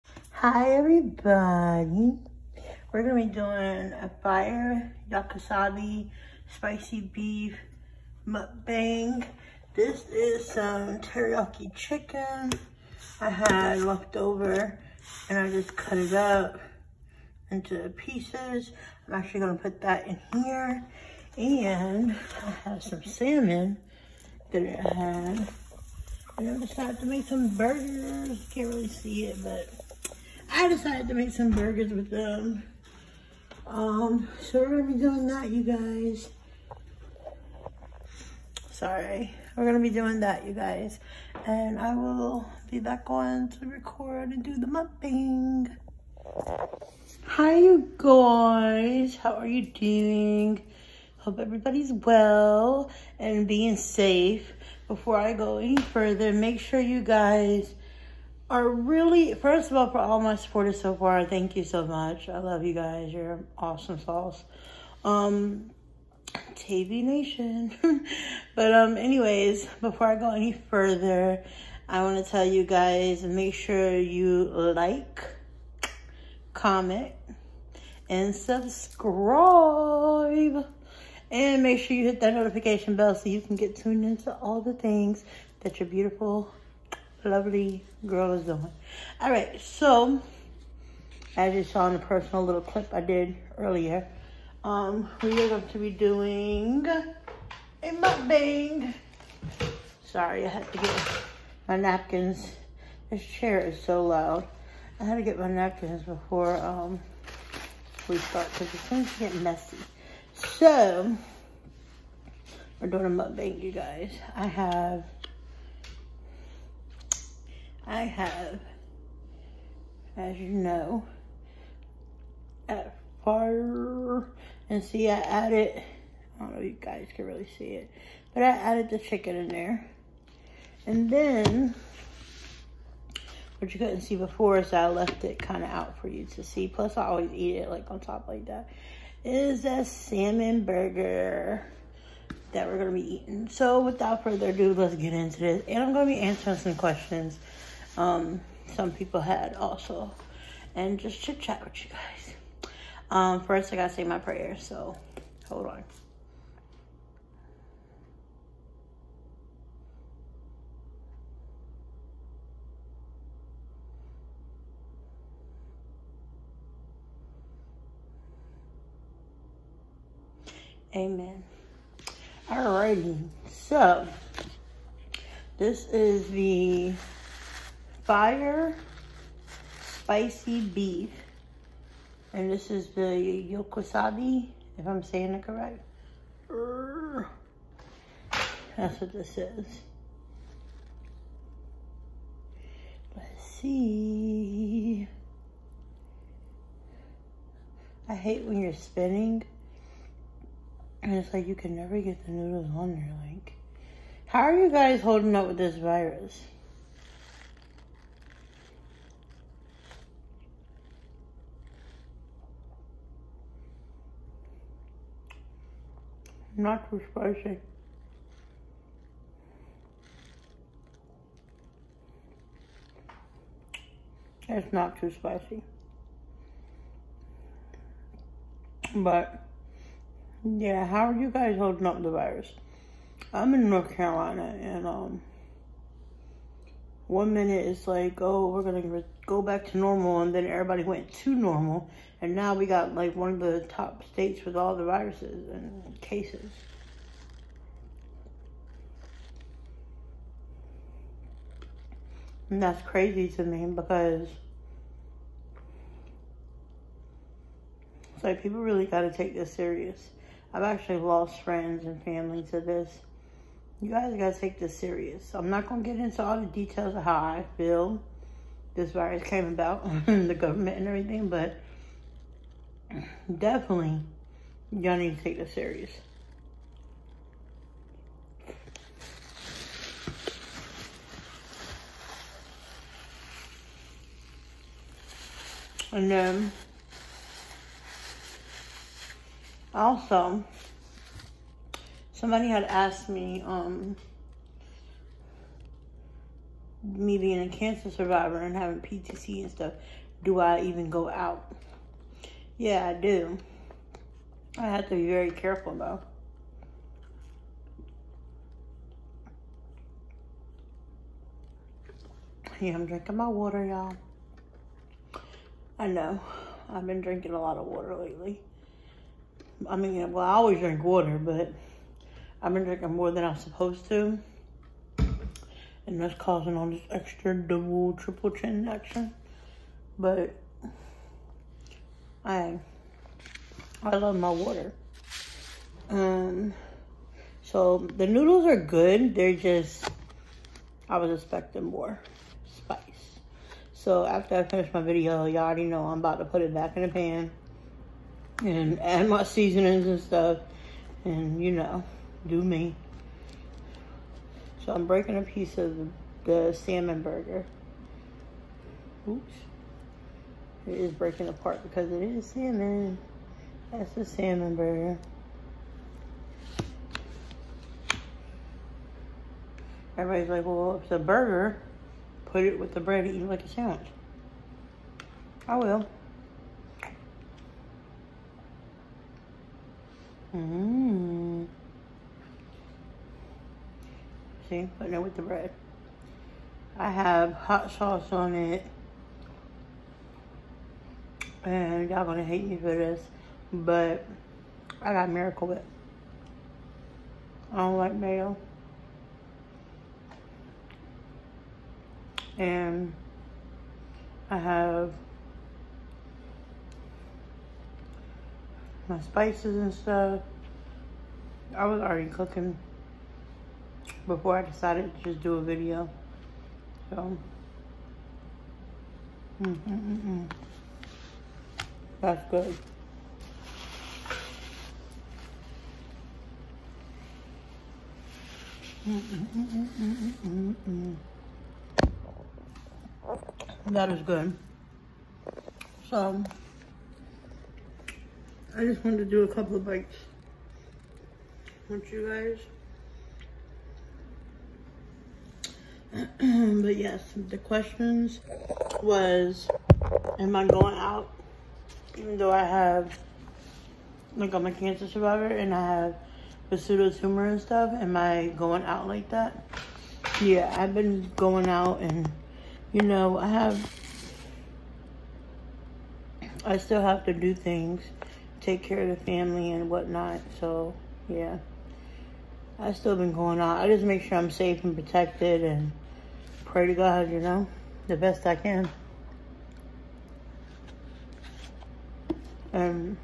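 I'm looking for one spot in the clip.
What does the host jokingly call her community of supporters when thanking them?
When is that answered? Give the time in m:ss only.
1:06.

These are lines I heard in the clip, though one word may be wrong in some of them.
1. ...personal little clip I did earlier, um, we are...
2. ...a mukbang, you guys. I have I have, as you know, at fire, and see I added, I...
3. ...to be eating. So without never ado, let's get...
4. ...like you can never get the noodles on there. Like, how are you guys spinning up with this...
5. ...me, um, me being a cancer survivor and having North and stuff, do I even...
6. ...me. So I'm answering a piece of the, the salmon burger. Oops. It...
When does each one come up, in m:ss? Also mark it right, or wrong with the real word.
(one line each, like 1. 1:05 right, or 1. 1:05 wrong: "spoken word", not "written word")
1. 1:31 right
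2. 1:53 right
3. 2:22 wrong: "further", not "never"
4. 3:21 wrong: "holding", not "spinning"
5. 4:53 wrong: "PTC", not "North"
6. 5:52 wrong: "breaking", not "answering".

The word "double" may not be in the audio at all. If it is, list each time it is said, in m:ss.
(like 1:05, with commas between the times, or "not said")
5:27.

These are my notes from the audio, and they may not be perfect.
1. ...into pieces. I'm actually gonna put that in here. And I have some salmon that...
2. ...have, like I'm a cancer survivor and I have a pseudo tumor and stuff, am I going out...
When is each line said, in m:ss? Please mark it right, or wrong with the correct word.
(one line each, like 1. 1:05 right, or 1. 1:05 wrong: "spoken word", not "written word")
1. 0:17 right
2. 7:32 right.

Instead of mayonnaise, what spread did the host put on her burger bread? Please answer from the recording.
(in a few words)
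Miracle Whip.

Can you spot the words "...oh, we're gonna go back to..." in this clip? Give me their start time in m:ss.
3:58.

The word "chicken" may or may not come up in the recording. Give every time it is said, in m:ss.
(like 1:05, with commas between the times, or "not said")
0:11, 2:08.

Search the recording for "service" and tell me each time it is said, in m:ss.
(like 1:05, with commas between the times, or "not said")
not said.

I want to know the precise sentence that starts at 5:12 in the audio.
Yeah, I'm drinking my water, y'all.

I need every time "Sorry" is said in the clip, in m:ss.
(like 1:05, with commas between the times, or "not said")
0:38, 1:40.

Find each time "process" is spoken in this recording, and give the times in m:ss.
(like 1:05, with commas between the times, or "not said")
not said.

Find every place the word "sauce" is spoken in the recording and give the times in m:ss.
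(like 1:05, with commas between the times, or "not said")
1:03, 6:27.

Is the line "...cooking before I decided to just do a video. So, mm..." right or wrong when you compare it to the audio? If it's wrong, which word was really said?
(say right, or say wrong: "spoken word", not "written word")
right.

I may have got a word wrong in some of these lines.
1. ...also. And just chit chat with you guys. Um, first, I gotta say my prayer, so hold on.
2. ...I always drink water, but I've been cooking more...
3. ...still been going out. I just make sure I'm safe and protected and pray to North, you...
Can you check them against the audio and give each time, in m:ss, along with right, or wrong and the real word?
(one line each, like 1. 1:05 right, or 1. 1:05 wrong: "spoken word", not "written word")
1. 2:29 right
2. 5:20 wrong: "drinking", not "cooking"
3. 7:52 wrong: "God", not "North".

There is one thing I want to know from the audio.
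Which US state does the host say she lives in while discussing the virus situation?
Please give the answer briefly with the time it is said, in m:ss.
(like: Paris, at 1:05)
North Carolina, at 3:53.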